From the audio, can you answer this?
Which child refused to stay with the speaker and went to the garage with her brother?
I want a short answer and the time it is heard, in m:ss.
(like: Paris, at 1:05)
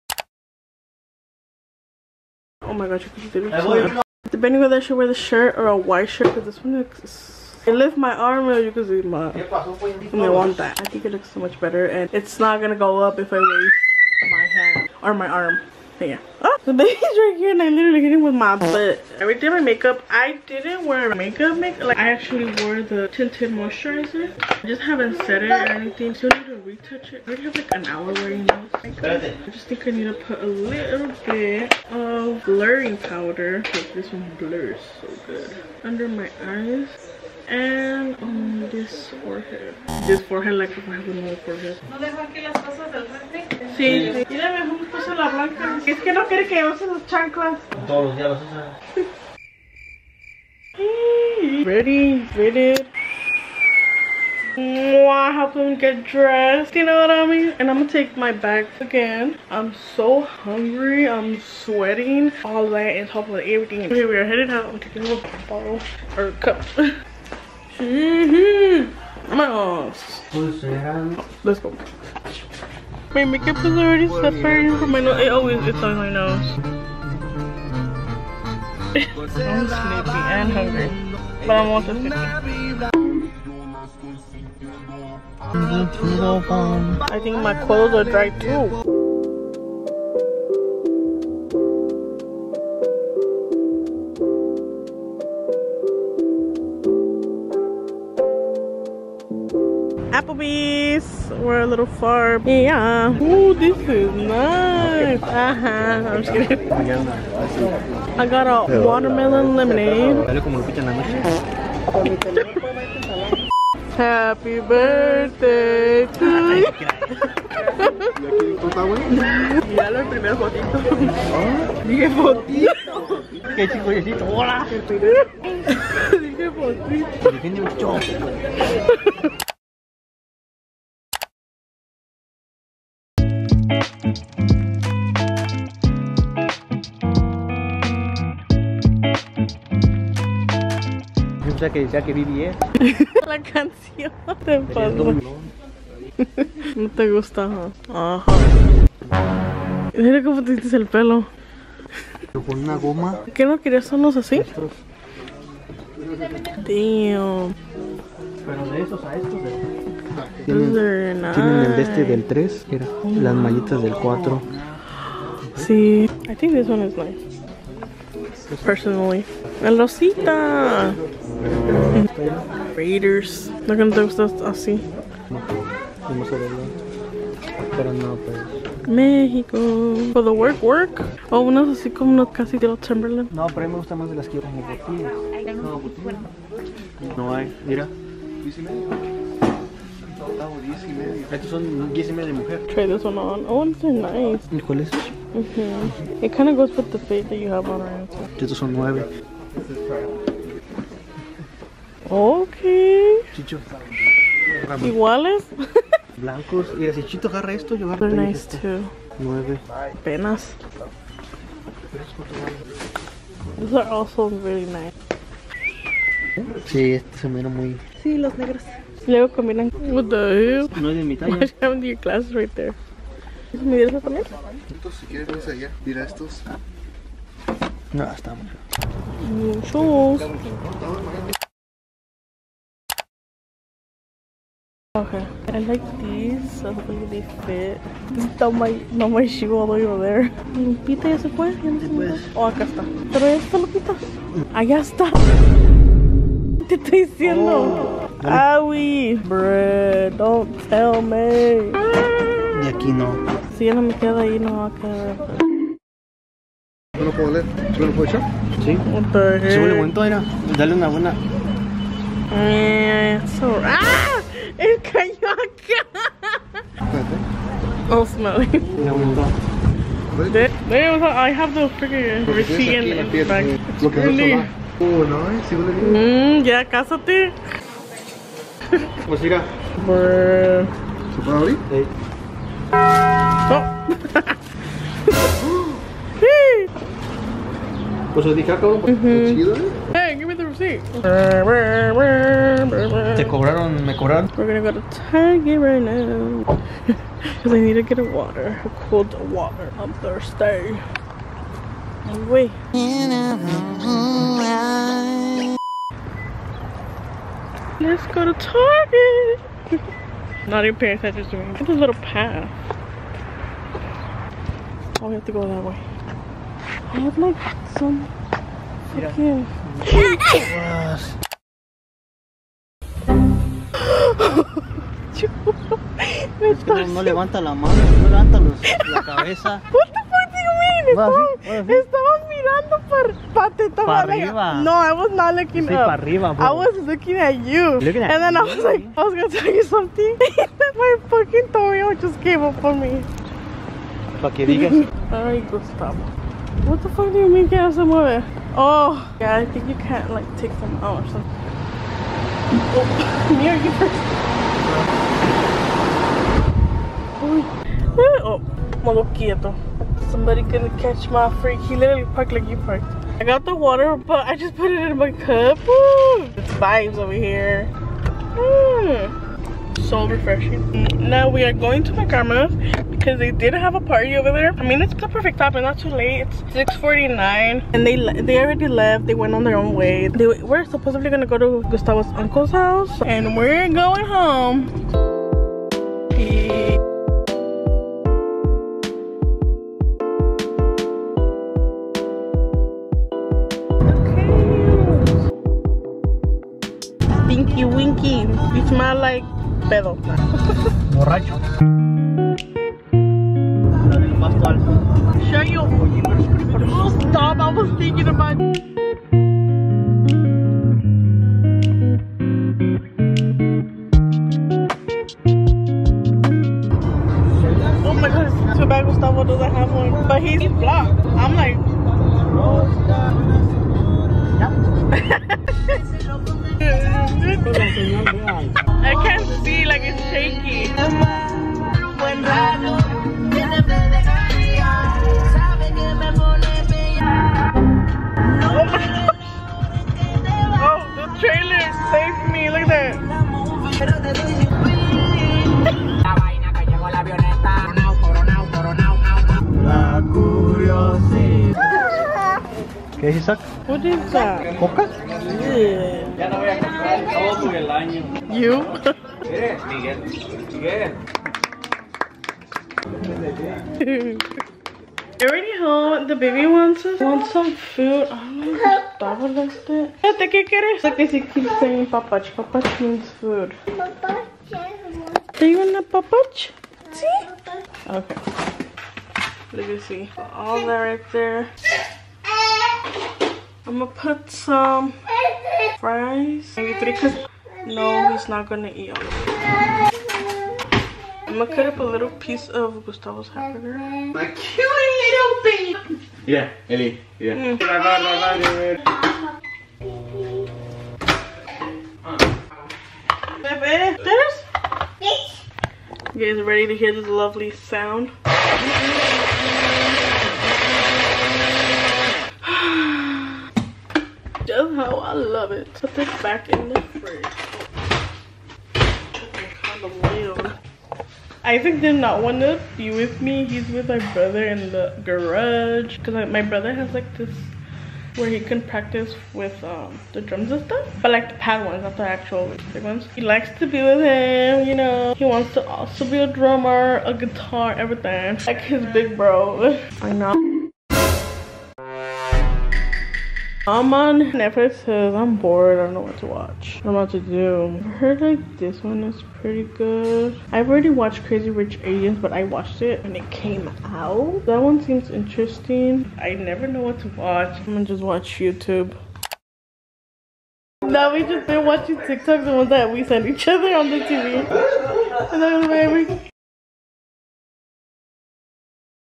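Isaac, at 8:41.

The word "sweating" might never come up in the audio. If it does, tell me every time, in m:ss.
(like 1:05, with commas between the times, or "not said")
1:01.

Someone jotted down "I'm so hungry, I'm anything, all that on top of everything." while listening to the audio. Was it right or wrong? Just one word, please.
wrong.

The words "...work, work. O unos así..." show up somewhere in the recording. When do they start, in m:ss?
3:00.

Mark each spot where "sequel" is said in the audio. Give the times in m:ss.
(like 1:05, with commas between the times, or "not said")
not said.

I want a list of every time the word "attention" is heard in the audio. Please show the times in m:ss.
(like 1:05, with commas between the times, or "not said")
5:10.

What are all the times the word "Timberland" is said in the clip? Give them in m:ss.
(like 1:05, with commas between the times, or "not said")
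3:02.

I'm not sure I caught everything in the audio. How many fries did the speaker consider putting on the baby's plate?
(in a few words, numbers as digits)
3.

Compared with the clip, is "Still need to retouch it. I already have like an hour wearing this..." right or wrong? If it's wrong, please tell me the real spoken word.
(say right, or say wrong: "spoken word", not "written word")
right.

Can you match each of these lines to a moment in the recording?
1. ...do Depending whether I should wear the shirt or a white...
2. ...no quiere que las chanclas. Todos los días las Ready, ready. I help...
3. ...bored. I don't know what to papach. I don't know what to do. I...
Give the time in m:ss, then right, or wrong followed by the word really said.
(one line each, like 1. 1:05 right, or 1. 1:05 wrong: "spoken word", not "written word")
1. 0:03 right
2. 0:46 right
3. 9:05 wrong: "watch", not "papach".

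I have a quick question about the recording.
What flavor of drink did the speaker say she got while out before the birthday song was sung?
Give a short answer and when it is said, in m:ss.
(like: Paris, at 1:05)
Watermelon lemonade, at 1:48.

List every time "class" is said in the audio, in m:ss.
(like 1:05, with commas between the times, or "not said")
3:41.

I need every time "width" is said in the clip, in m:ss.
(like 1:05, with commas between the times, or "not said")
not said.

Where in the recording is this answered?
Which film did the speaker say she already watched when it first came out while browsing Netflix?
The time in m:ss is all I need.
9:11.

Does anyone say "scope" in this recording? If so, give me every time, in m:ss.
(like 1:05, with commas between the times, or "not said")
not said.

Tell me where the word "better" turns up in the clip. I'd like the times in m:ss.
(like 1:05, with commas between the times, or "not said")
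0:11.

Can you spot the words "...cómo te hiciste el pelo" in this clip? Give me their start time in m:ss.
2:30.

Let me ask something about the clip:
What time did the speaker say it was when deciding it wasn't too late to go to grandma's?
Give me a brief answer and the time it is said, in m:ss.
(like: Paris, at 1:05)
6:49, at 6:16.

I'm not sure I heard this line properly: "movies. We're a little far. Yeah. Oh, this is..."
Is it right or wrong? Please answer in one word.
right.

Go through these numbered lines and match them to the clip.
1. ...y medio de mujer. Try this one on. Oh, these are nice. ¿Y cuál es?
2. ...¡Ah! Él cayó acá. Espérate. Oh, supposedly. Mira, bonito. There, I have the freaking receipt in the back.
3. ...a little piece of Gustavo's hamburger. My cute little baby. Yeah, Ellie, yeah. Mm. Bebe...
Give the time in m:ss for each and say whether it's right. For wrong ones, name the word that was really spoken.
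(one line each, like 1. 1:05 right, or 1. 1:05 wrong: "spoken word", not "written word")
1. 3:12 right
2. 4:23 wrong: "smelly", not "supposedly"
3. 8:11 right.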